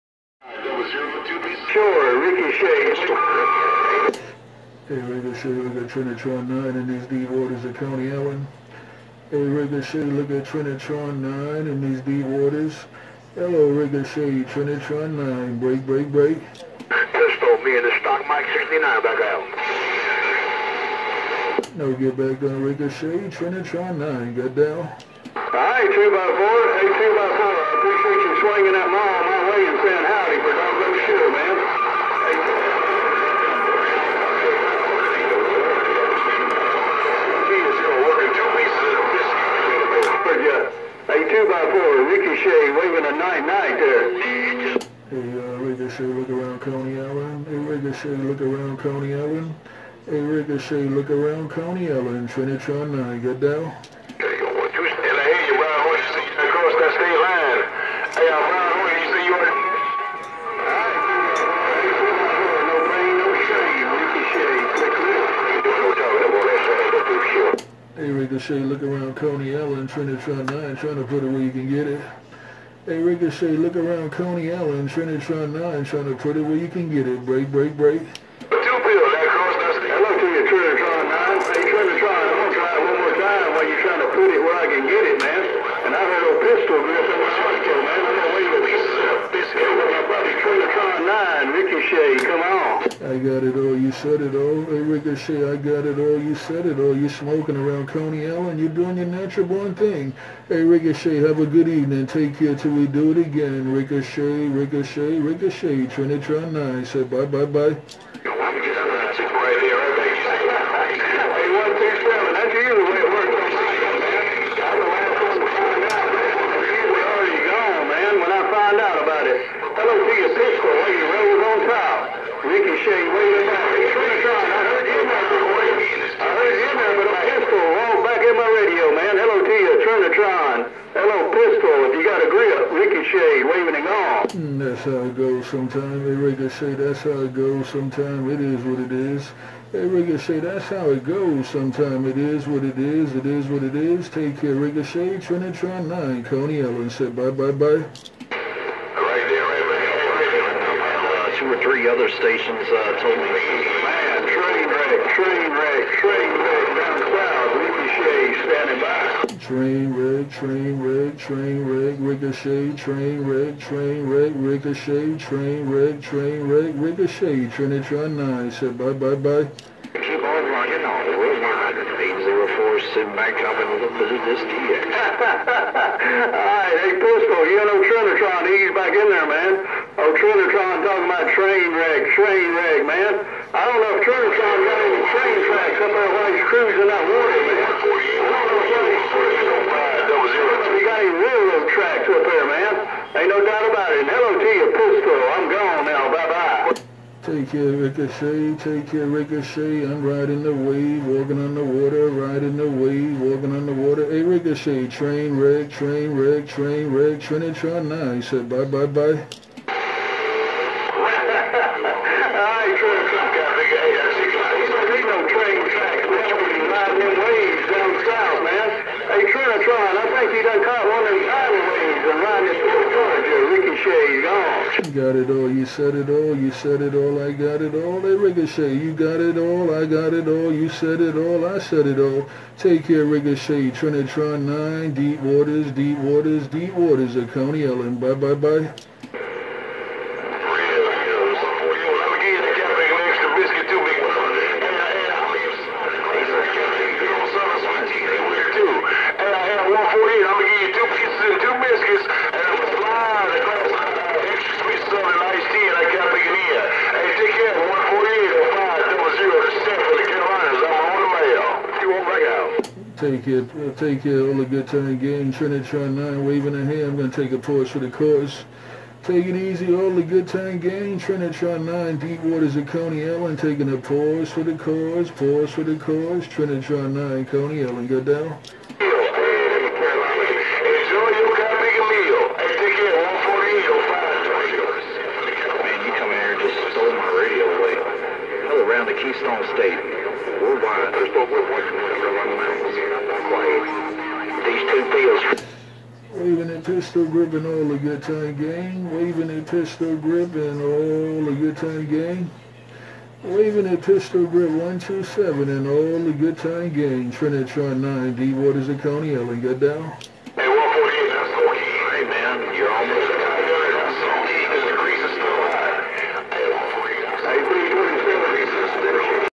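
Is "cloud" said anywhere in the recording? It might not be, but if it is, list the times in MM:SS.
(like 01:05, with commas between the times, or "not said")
02:37.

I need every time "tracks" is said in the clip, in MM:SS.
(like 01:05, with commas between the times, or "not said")
03:05, 03:11.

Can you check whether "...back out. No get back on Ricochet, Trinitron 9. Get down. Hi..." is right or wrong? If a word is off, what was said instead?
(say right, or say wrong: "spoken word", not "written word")
right.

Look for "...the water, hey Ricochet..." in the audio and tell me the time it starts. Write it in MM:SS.
03:23.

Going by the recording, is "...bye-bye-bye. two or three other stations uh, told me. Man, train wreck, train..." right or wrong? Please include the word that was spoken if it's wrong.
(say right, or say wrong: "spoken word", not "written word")
right.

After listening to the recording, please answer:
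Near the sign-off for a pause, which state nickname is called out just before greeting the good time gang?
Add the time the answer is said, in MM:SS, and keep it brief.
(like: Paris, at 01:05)
Keystone State, at 04:49.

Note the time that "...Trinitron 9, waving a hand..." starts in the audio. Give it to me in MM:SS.
04:25.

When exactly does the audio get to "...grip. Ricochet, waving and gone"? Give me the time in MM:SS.
02:12.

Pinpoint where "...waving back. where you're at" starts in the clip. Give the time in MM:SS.
02:03.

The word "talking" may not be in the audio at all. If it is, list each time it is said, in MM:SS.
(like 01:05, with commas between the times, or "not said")
03:00.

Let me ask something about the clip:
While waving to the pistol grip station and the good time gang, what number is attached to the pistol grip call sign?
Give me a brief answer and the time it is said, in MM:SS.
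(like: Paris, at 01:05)
127, at 05:04.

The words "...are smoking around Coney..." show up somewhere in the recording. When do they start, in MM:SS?
01:37.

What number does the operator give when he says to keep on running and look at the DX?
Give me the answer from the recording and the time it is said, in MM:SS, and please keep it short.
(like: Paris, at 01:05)
804, at 02:52.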